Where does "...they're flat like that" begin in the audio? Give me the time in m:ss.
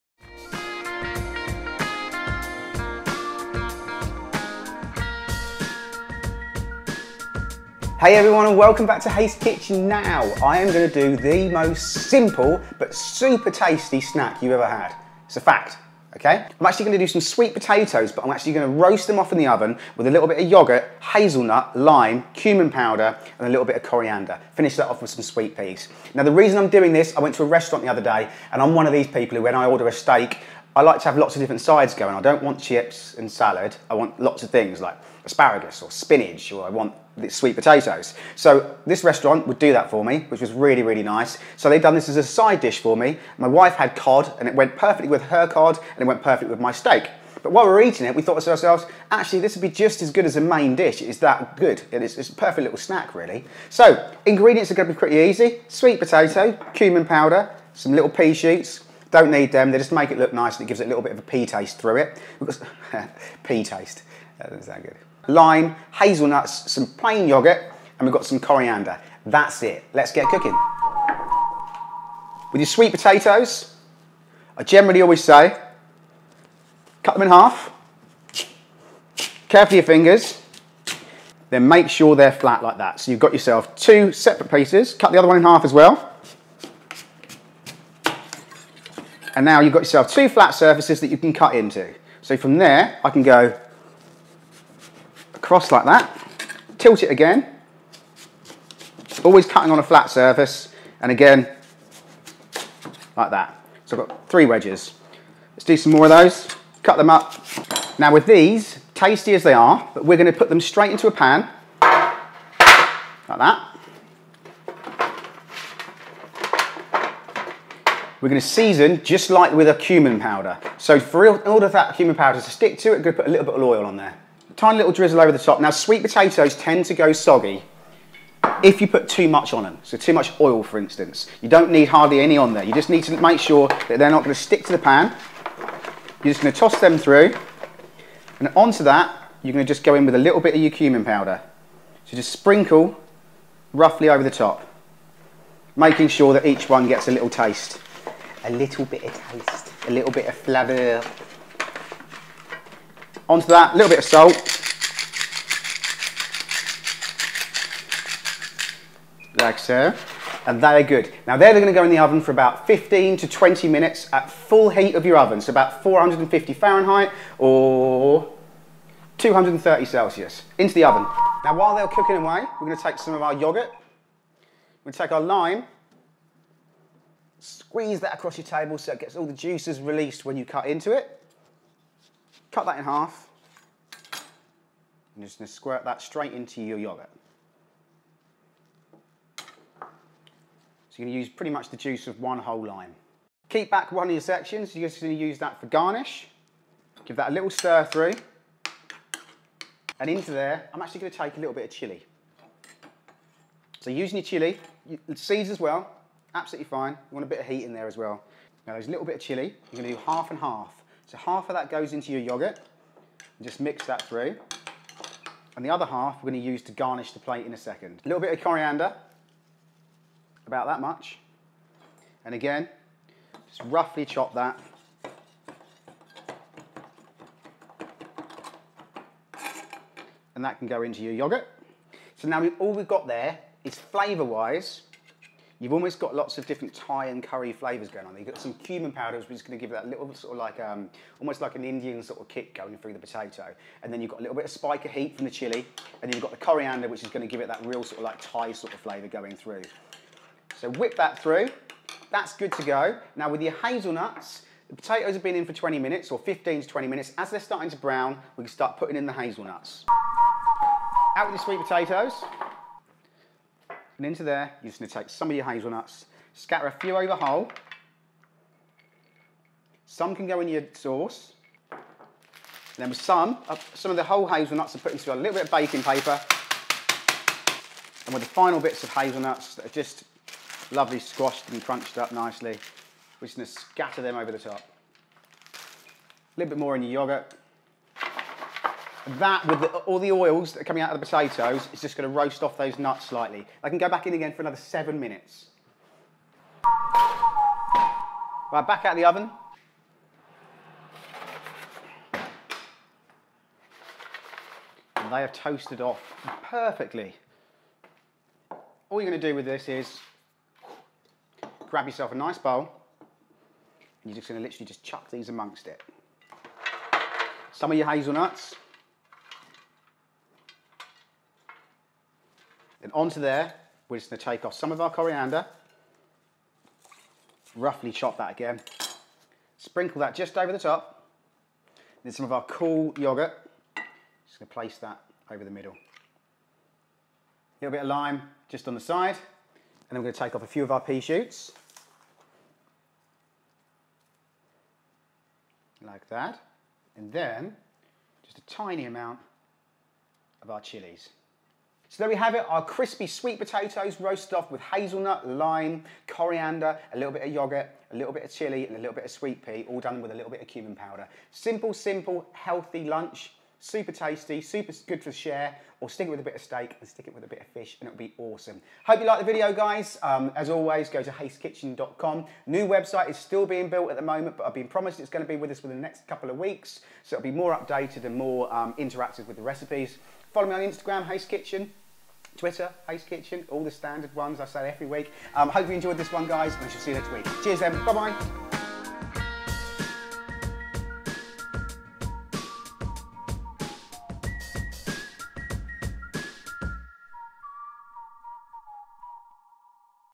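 1:22.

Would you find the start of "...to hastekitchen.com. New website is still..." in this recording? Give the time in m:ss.
6:11.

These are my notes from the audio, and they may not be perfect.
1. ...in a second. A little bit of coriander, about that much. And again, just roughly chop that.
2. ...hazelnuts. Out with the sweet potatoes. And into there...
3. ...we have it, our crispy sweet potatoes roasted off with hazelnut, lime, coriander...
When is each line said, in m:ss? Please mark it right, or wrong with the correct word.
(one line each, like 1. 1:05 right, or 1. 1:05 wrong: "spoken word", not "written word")
1. 3:37 right
2. 4:19 right
3. 5:52 right.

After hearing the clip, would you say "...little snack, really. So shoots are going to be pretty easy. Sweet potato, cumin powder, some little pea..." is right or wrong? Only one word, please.
wrong.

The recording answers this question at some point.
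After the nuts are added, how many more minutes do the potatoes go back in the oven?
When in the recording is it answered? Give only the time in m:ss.
4:54.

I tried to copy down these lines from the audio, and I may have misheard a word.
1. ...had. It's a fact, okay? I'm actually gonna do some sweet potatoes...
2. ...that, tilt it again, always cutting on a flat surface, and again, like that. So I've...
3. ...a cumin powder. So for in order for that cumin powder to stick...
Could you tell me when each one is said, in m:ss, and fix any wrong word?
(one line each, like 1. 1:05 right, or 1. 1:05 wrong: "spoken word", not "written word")
1. 0:14 right
2. 1:35 right
3. 1:59 right.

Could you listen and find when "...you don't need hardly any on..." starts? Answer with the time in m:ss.
2:11.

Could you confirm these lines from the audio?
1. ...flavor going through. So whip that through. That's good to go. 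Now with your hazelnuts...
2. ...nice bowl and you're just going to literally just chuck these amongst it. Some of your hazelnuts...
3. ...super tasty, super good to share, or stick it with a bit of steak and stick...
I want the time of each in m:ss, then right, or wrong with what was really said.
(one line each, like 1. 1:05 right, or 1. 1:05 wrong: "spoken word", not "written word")
1. 4:08 right
2. 5:12 right
3. 6:03 right.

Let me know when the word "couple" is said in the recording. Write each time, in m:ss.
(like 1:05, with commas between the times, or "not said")
6:16.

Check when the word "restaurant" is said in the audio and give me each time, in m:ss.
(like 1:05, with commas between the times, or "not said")
0:27, 0:39.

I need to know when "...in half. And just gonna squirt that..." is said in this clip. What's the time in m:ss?
3:02.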